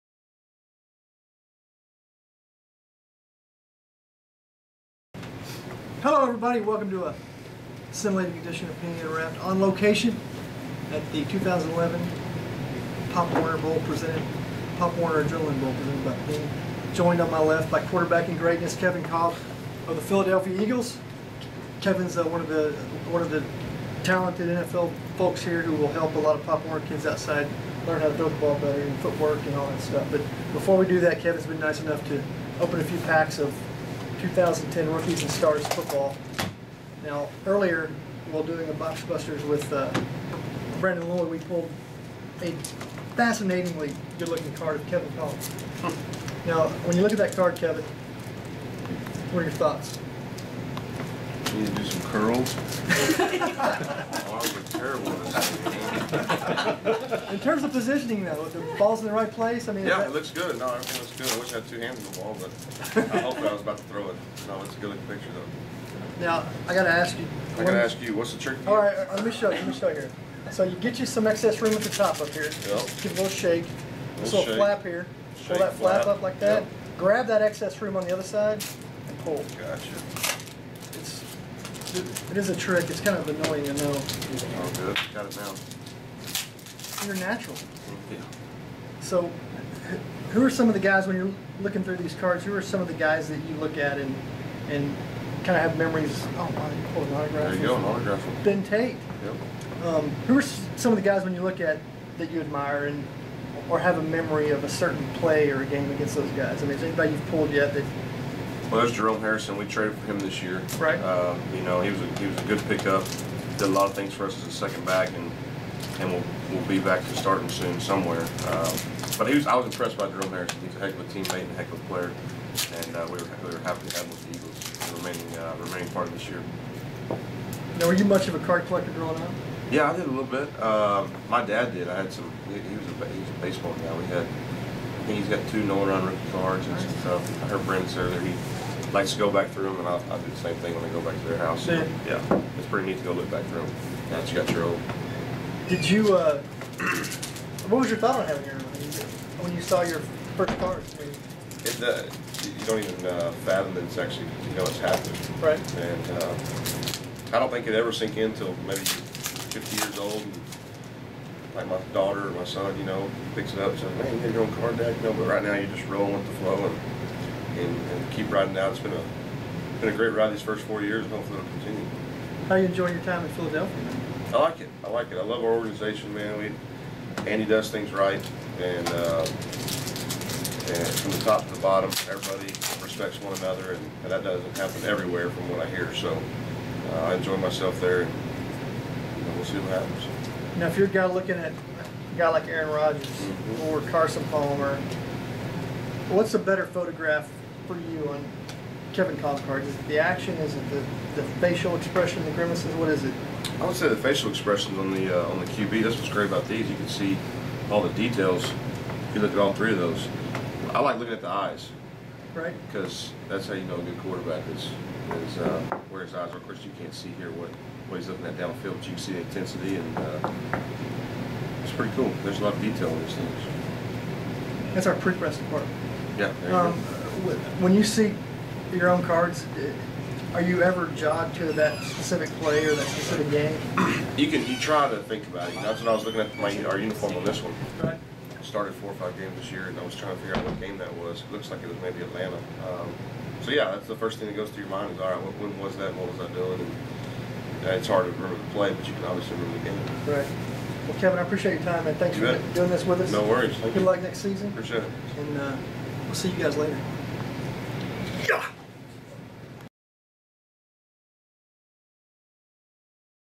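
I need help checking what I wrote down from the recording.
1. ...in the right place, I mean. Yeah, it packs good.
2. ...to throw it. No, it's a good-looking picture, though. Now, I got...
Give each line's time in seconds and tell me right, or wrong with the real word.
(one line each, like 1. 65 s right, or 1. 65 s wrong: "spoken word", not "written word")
1. 59 s wrong: "looks", not "packs"
2. 63 s right.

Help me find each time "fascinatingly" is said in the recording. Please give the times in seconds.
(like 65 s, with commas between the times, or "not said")
43 s.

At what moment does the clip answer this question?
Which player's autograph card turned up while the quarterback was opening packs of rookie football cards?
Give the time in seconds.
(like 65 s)
98 s.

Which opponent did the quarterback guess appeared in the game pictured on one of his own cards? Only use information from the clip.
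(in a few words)
Atlanta.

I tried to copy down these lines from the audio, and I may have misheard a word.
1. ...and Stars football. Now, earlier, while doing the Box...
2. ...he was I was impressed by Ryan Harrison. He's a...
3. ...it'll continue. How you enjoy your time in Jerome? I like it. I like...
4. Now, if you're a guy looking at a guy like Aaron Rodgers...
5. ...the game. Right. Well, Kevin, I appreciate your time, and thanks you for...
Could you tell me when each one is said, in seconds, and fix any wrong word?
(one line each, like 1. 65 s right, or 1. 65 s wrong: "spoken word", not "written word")
1. 35 s right
2. 119 s wrong: "Jerome", not "Ryan"
3. 171 s wrong: "Philadelphia", not "Jerome"
4. 190 s right
5. 249 s right.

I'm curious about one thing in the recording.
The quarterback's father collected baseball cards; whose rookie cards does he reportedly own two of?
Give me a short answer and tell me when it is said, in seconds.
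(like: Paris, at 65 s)
Nolan Ryan, at 135 s.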